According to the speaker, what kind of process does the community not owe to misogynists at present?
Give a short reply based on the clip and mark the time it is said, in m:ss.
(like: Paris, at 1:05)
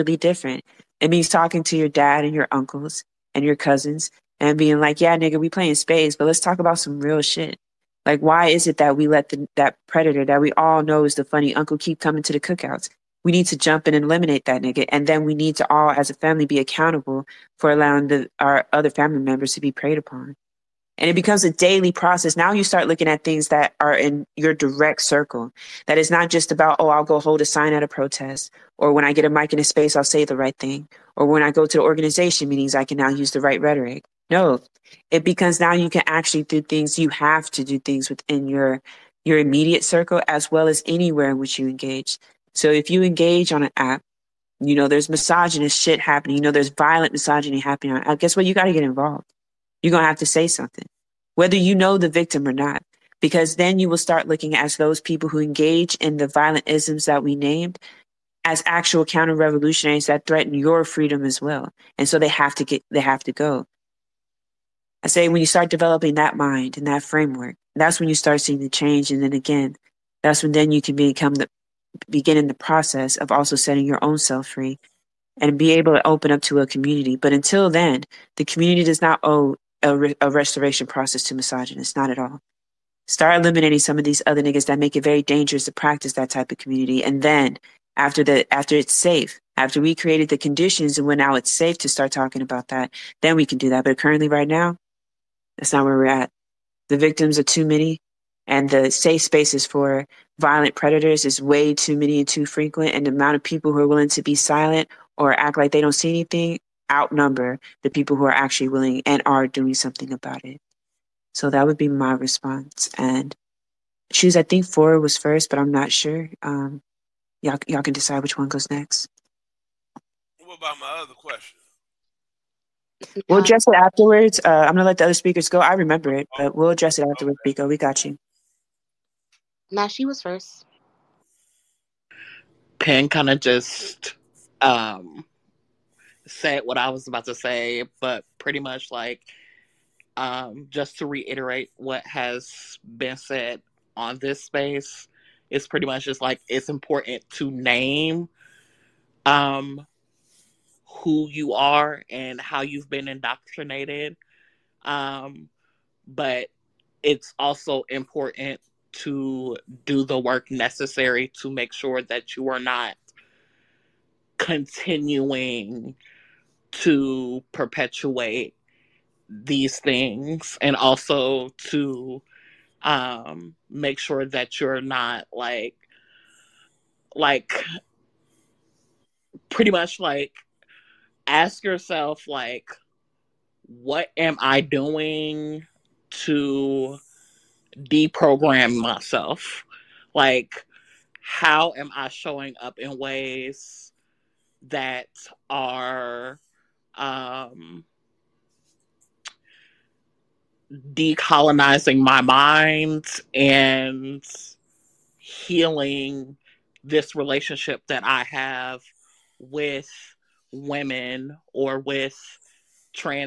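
A restoration process, at 1:20.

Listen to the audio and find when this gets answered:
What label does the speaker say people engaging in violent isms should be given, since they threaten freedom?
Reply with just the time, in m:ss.
0:59.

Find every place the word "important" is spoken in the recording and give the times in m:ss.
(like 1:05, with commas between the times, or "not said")
2:26, 2:37.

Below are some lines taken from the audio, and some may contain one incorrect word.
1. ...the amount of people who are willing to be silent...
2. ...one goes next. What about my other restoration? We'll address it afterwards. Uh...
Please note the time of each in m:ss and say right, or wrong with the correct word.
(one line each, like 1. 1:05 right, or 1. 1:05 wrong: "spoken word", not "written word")
1. 1:43 right
2. 1:58 wrong: "question", not "restoration".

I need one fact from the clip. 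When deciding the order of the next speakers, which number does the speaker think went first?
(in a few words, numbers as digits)
4.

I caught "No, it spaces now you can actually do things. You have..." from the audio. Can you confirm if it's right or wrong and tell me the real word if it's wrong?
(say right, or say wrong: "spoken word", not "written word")
wrong: "becomes", not "spaces".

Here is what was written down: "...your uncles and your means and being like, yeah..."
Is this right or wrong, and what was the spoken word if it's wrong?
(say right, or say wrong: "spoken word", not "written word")
wrong: "cousins", not "means".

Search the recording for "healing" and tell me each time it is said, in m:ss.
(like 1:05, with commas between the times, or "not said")
3:25.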